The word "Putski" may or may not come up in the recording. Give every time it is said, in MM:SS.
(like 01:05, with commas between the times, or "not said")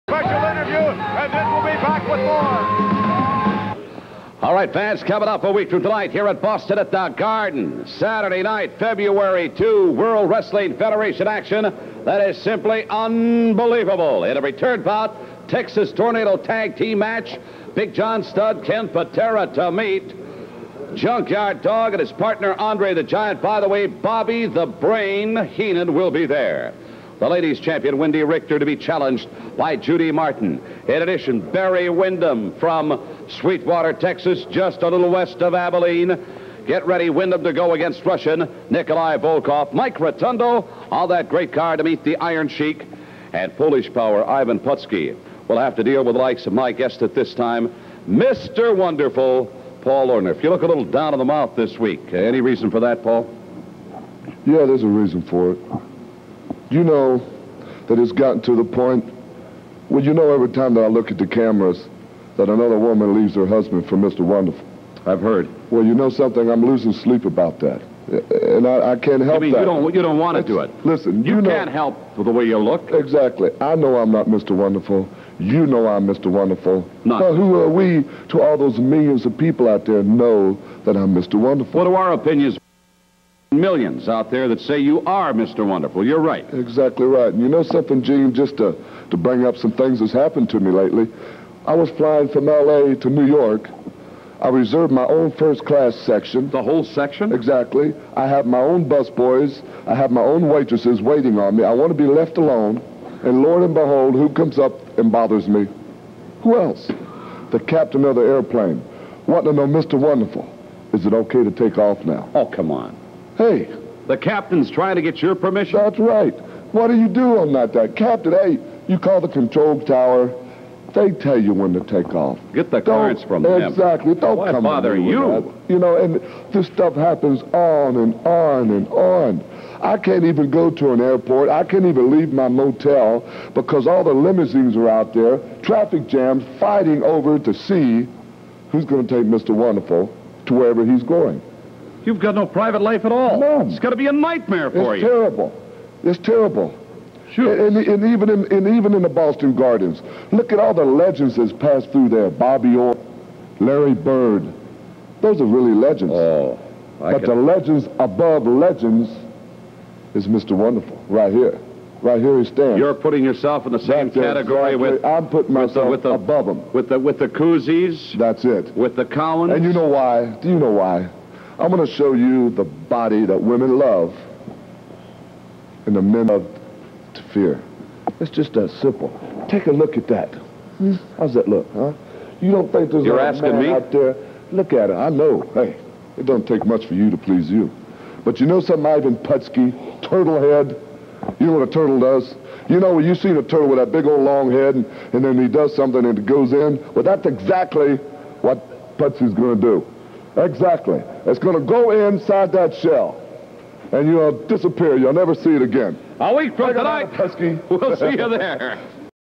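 00:44, 03:09, 03:18.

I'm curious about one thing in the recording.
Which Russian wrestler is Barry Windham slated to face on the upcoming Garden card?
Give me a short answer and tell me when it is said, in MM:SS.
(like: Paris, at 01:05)
Nikolai Volkov, at 00:38.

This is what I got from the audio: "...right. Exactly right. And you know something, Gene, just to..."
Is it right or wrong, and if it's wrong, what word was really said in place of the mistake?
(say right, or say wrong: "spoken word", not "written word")
right.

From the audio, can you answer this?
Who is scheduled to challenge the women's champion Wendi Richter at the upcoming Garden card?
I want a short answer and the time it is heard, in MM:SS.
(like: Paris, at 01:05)
Judy Martin, at 00:29.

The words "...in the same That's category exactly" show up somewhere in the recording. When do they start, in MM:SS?
02:43.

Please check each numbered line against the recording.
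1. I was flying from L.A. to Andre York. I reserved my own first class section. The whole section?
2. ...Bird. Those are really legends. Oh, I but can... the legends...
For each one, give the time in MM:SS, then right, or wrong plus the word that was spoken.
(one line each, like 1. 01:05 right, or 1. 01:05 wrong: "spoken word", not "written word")
1. 01:31 wrong: "New", not "Andre"
2. 02:33 right.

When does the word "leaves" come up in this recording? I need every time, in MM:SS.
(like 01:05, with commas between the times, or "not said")
01:03, 02:12.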